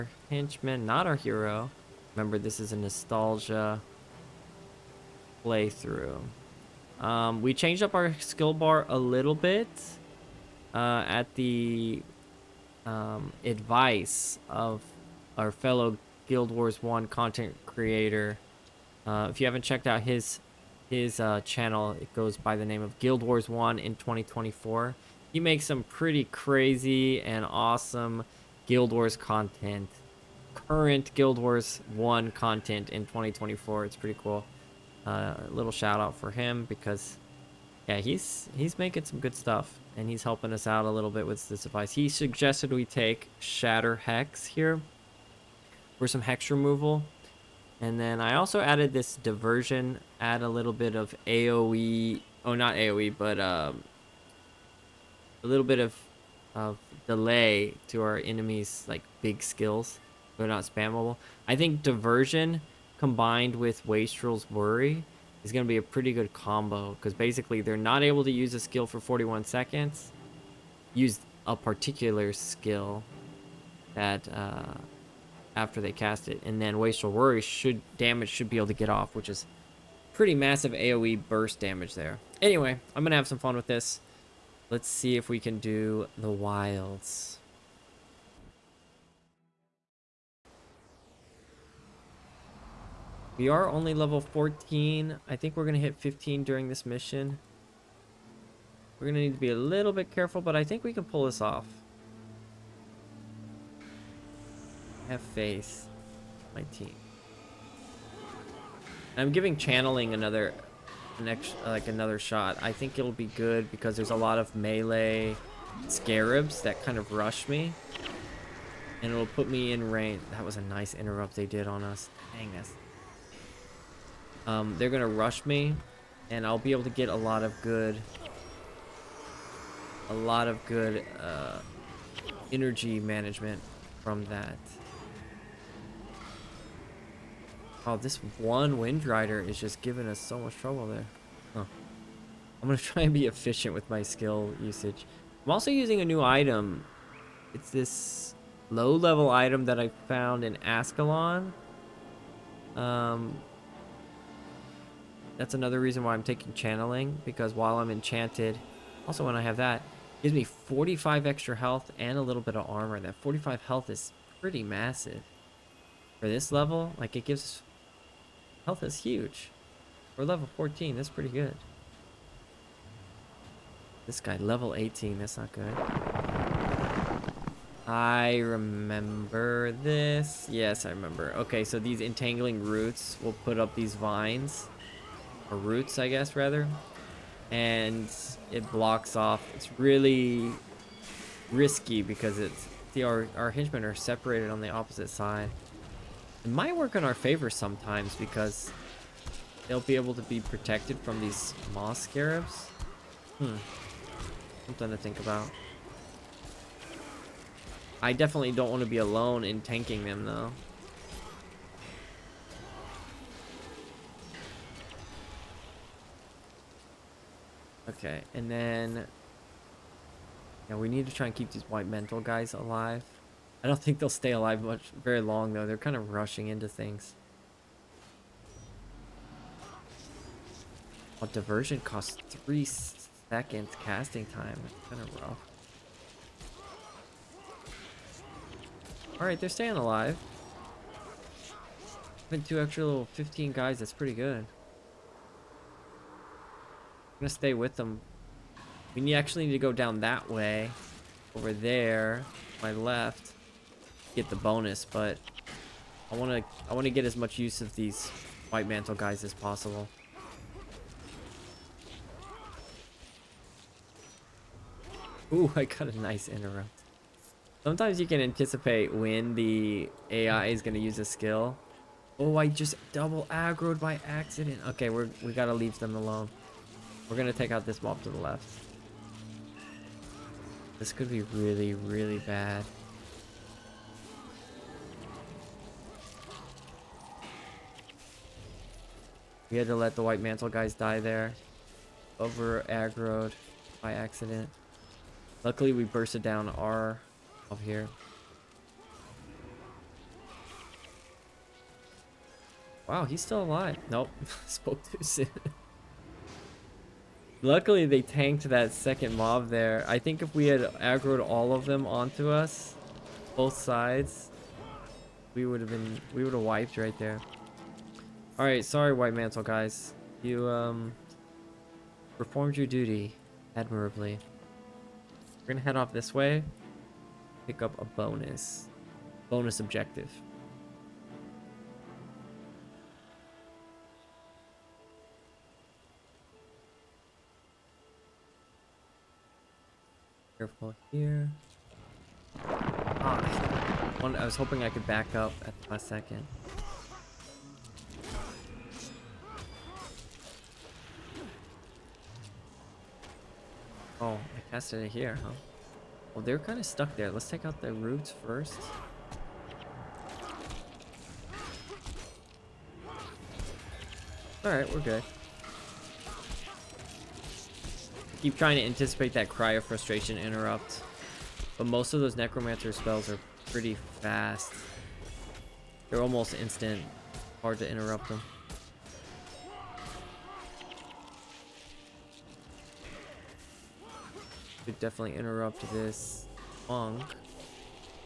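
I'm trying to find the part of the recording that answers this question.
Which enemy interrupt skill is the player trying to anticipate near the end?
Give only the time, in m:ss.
6:09.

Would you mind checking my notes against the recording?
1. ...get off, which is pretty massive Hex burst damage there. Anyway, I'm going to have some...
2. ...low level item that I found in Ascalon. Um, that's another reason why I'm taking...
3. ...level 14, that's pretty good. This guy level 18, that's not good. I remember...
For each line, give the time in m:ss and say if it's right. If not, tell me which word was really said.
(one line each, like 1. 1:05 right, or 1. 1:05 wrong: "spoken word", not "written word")
1. 1:18 wrong: "AoE", not "Hex"
2. 2:28 right
3. 2:50 right.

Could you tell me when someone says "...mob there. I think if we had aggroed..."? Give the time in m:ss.
5:09.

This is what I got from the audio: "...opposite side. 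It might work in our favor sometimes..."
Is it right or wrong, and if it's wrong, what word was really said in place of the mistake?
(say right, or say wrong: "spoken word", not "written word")
right.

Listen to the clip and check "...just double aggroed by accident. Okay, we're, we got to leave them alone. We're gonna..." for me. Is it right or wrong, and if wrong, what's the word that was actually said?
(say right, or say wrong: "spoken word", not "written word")
right.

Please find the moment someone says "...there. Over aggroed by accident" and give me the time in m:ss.
4:50.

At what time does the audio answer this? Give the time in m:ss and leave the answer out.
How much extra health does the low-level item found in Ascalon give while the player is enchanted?
2:40.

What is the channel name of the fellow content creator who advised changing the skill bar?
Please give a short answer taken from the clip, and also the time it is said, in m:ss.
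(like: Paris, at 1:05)
Guild Wars 1 in 2024, at 0:22.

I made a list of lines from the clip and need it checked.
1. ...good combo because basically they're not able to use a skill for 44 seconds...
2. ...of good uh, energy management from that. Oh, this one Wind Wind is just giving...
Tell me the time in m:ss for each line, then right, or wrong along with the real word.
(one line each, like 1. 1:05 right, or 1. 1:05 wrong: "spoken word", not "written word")
1. 1:06 wrong: "41", not "44"
2. 2:10 wrong: "Rider", not "Wind".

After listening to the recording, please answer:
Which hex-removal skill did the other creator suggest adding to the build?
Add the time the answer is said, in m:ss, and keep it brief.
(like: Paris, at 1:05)
Shatter Hex, at 0:43.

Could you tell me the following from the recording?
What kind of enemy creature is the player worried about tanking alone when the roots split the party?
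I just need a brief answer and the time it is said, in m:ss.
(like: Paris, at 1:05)
moss scarabs, at 3:21.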